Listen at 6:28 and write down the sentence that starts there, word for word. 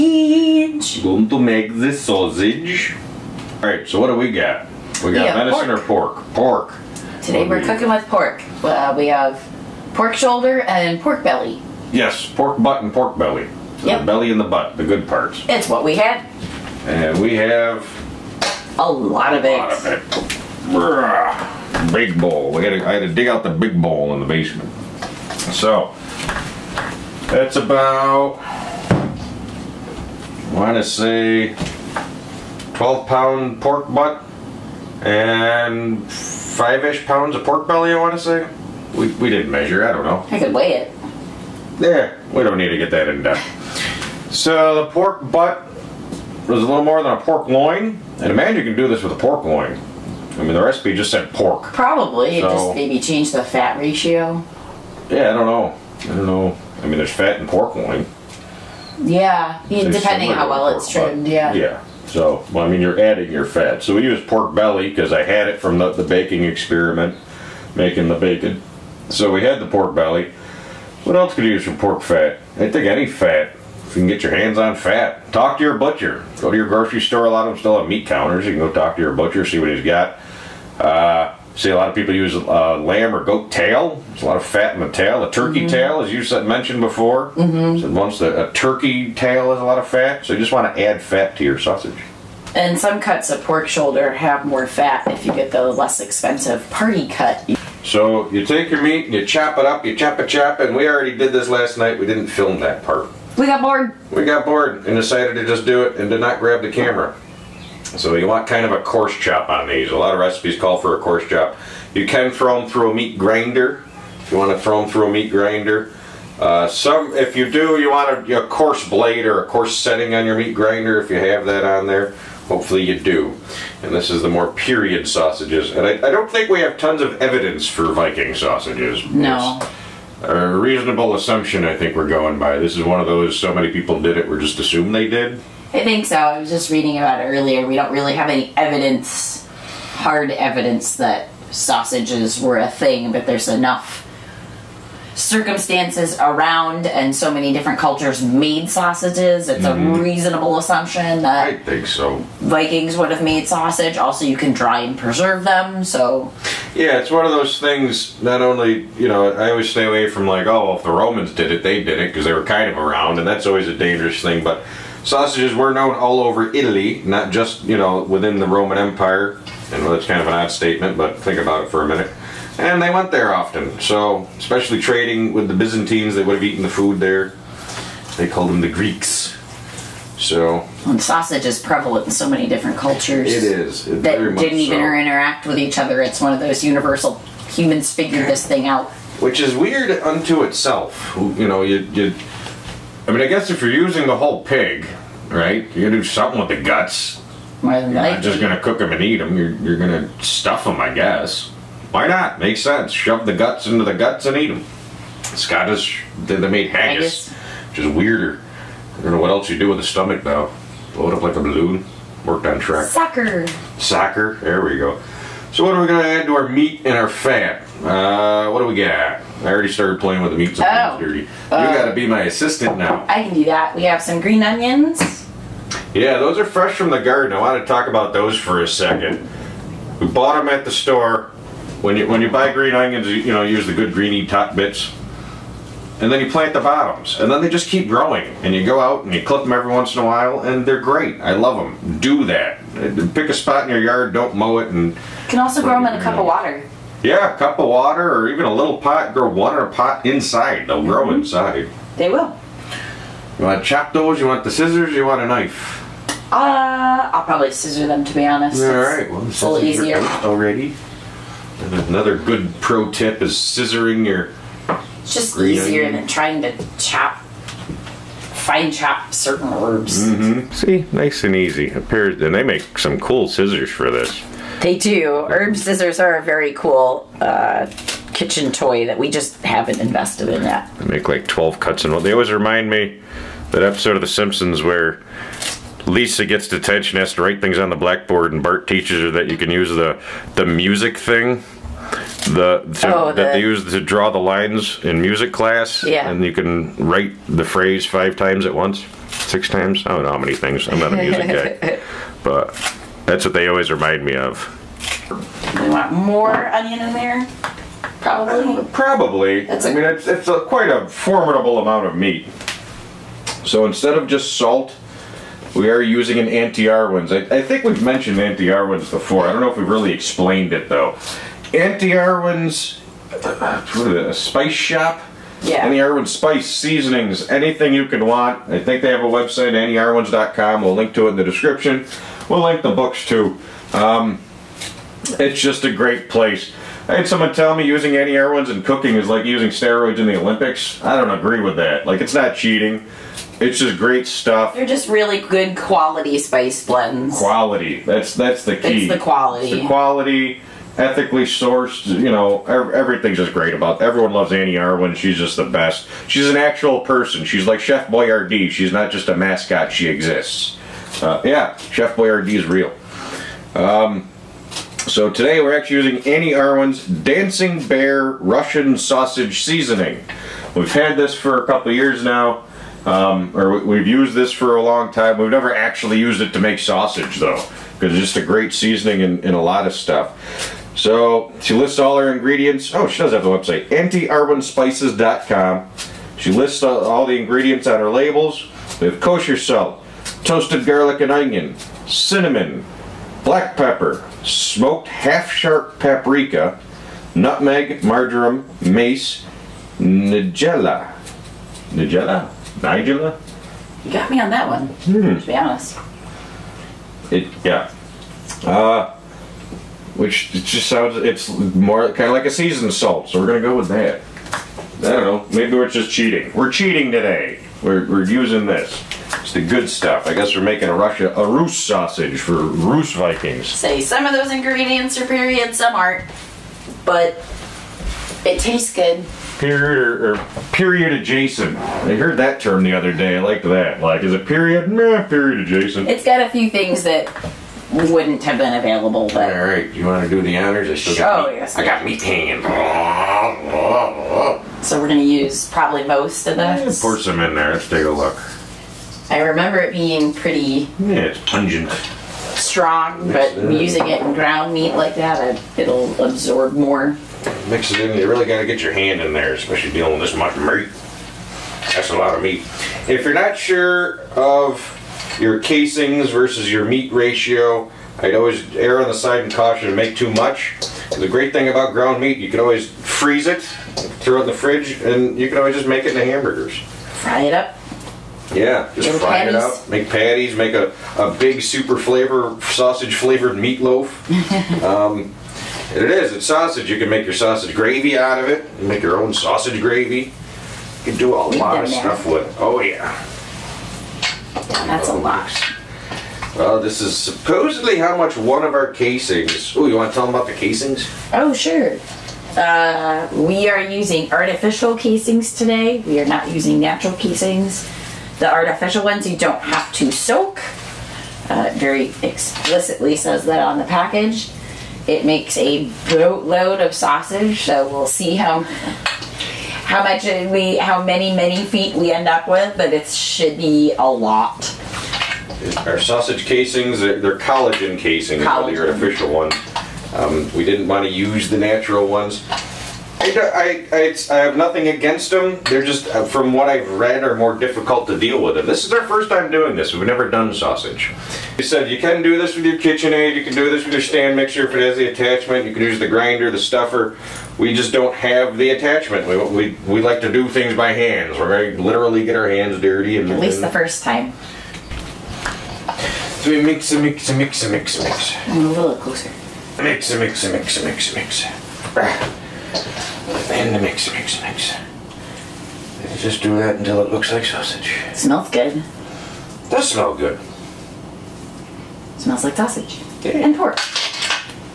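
We have kosher salt, toasted garlic and onion, cinnamon, black pepper, smoked half sharp paprika, nutmeg, marjoram, mace, nigella.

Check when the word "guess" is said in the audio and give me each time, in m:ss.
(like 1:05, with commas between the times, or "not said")
3:13, 3:20, 7:00.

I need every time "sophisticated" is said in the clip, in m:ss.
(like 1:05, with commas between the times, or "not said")
not said.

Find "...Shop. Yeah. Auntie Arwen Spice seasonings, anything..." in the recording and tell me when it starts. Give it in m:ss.
5:24.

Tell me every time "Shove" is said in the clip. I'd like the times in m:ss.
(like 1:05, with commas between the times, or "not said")
3:22.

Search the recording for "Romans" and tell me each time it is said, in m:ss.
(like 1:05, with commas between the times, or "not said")
2:40, 2:48.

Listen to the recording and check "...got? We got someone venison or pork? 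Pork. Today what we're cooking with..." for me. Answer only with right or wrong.
wrong.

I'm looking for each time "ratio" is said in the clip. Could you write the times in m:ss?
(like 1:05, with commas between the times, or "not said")
0:53, 7:46.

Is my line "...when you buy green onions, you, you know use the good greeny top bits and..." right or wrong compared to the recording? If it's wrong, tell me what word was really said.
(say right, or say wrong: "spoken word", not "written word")
right.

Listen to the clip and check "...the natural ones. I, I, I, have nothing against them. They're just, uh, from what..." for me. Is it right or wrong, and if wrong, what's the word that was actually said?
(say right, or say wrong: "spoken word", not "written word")
right.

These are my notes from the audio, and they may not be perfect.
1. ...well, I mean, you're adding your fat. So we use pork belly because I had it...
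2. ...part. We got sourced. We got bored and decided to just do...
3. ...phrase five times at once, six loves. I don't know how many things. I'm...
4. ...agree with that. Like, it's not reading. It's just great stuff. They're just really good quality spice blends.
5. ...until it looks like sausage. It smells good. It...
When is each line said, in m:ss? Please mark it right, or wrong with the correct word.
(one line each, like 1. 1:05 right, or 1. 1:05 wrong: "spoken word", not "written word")
1. 1:02 right
2. 1:42 wrong: "bored", not "sourced"
3. 4:57 wrong: "times", not "loves"
4. 5:41 wrong: "cheating", not "reading"
5. 9:26 right.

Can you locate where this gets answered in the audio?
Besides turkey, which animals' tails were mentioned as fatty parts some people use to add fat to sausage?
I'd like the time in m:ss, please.
1:22.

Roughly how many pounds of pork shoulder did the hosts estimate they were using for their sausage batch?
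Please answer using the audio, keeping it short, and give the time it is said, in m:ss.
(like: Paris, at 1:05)
12, at 0:32.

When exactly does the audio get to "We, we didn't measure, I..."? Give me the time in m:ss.
0:38.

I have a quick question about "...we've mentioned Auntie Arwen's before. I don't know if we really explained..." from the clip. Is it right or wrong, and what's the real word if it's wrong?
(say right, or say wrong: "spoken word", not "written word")
right.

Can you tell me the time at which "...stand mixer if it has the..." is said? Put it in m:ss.
9:03.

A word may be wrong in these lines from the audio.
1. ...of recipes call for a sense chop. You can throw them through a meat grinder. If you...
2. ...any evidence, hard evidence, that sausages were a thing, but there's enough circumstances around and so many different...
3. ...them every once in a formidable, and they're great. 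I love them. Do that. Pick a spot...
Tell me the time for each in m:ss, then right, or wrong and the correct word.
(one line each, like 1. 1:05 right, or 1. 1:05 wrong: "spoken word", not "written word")
1. 1:50 wrong: "coarse", not "sense"
2. 2:18 right
3. 3:59 wrong: "while", not "formidable".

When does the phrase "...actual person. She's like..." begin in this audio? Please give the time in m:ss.
5:56.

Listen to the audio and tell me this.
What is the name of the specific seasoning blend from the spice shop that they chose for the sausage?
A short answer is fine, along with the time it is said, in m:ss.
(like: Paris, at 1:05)
Dancing Bear Russian Sausage Seasoning, at 6:06.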